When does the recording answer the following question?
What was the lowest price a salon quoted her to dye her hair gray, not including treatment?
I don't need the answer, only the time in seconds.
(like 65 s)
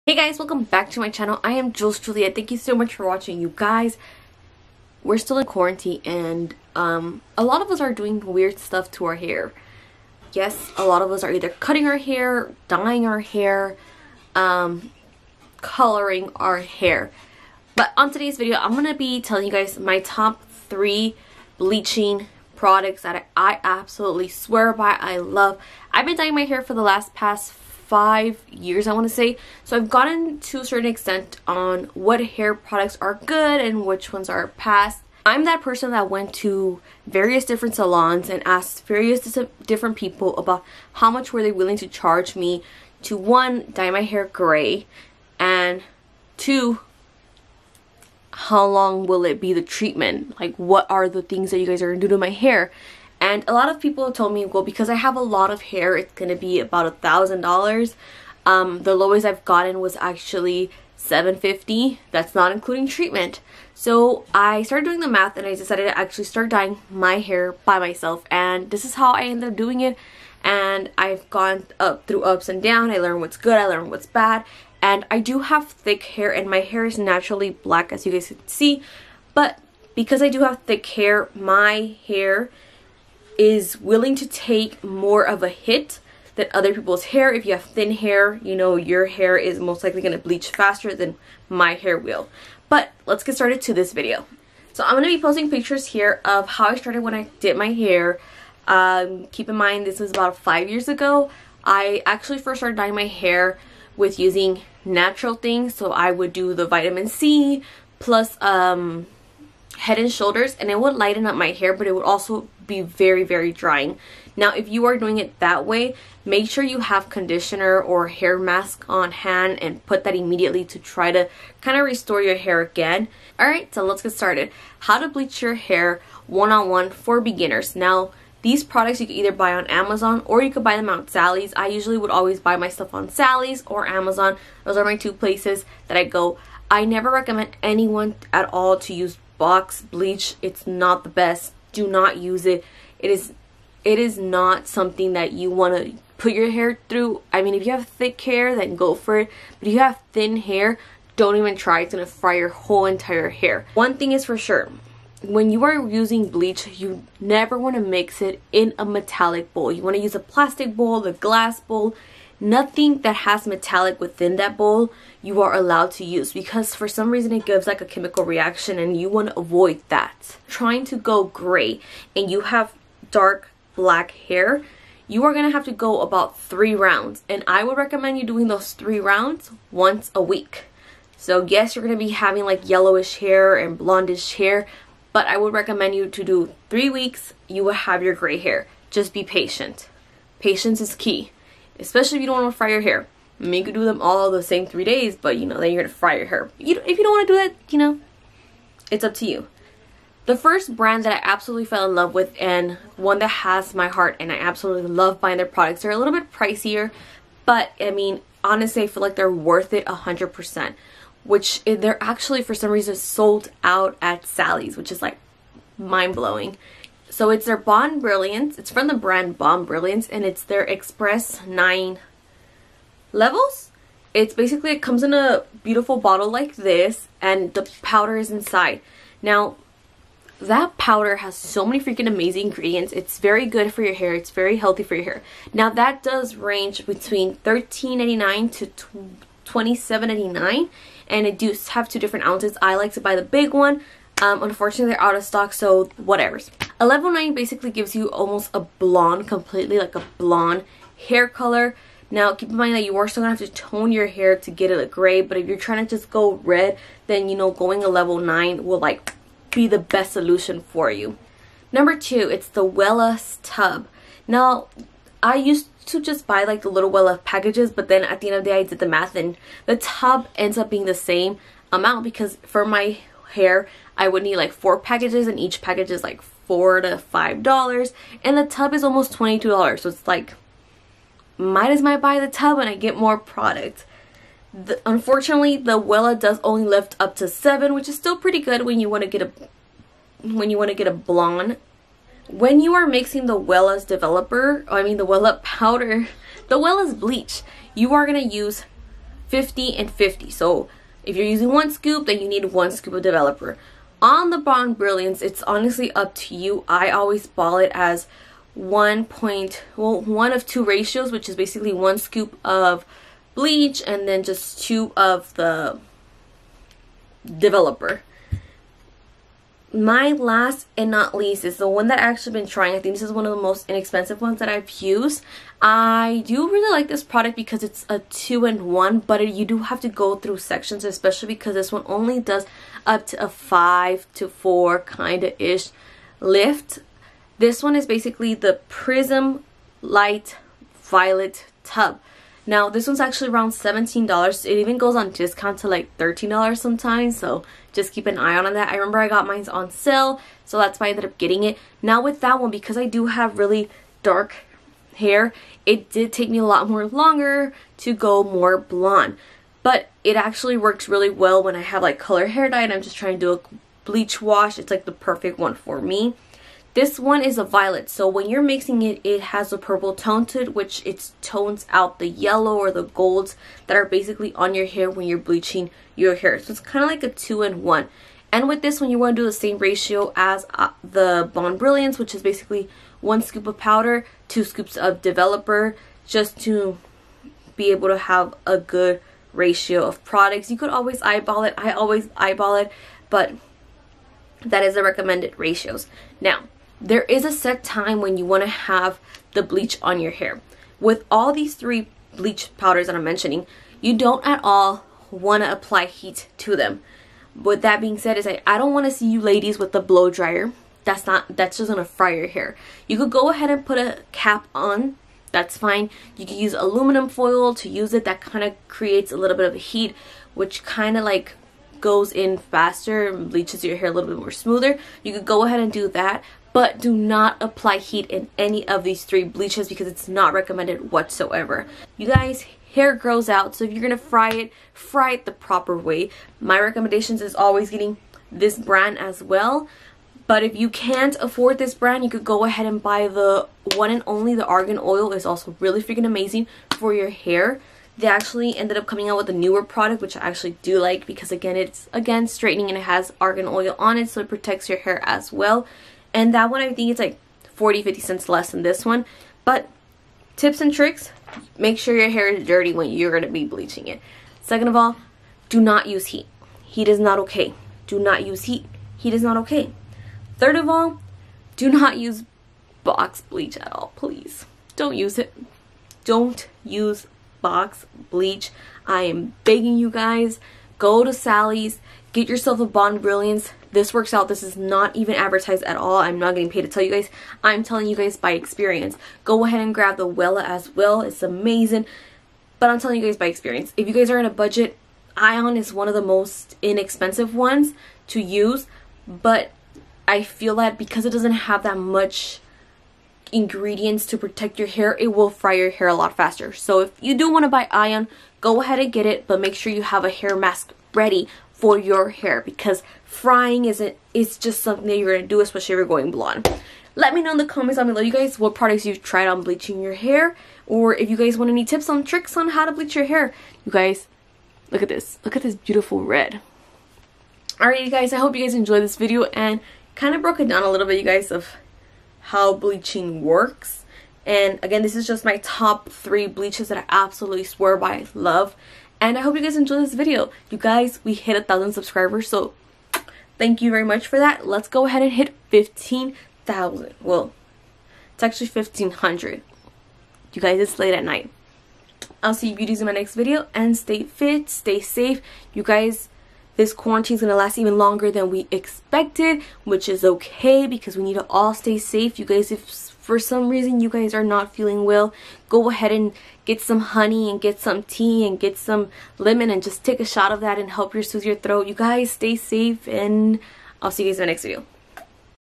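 60 s.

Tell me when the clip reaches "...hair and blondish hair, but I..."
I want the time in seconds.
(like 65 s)
183 s.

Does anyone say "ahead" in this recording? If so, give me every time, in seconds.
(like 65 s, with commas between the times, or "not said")
413 s, 425 s, 442 s, 489 s, 508 s, 544 s, 565 s.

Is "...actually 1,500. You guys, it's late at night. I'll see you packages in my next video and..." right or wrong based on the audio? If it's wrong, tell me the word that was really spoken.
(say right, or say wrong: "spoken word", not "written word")
wrong: "beauties", not "packages".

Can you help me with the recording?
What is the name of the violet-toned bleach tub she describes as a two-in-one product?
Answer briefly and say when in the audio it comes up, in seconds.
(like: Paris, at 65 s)
Prism Light Violet Tub, at 338 s.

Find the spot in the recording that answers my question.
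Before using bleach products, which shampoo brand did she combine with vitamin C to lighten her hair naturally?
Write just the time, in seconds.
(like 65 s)
109 s.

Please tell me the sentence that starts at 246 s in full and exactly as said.
1109 basically gives you almost a blonde, completely like a blonde hair color.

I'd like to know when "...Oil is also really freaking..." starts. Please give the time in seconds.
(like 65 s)
444 s.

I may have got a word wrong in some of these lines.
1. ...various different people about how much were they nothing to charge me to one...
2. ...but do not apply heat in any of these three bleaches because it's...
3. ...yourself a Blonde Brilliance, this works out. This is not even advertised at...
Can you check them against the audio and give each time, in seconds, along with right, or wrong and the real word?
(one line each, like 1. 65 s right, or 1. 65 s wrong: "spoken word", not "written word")
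1. 38 s wrong: "willing", not "nothing"
2. 426 s right
3. 482 s right.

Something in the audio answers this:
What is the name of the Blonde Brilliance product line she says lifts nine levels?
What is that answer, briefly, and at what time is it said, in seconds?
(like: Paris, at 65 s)
Express 9, at 220 s.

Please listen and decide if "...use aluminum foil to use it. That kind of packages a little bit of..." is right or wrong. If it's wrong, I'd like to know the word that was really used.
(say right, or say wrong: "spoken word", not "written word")
wrong: "creates", not "packages".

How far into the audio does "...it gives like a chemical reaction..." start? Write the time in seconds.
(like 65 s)
167 s.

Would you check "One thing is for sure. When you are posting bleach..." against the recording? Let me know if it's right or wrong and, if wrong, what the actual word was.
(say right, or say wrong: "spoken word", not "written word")
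wrong: "using", not "posting".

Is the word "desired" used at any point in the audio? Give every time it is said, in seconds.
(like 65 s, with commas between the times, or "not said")
not said.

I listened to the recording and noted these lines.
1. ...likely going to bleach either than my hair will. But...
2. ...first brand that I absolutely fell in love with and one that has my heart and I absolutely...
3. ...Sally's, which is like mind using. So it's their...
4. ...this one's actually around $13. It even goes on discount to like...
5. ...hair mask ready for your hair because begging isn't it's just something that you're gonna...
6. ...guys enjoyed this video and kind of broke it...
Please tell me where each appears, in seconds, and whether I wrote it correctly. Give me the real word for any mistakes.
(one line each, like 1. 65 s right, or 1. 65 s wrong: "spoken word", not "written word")
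1. 89 s wrong: "faster", not "either"
2. 200 s right
3. 214 s wrong: "blowing", not "using"
4. 342 s wrong: "17", not "13"
5. 510 s wrong: "frying", not "begging"
6. 528 s right.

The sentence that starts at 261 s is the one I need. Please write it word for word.
Number two, it's the Wella Tub.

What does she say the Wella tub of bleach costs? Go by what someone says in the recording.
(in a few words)
$22.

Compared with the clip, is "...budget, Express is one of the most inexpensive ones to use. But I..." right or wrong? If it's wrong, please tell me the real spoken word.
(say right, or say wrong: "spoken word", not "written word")
wrong: "Ion", not "Express".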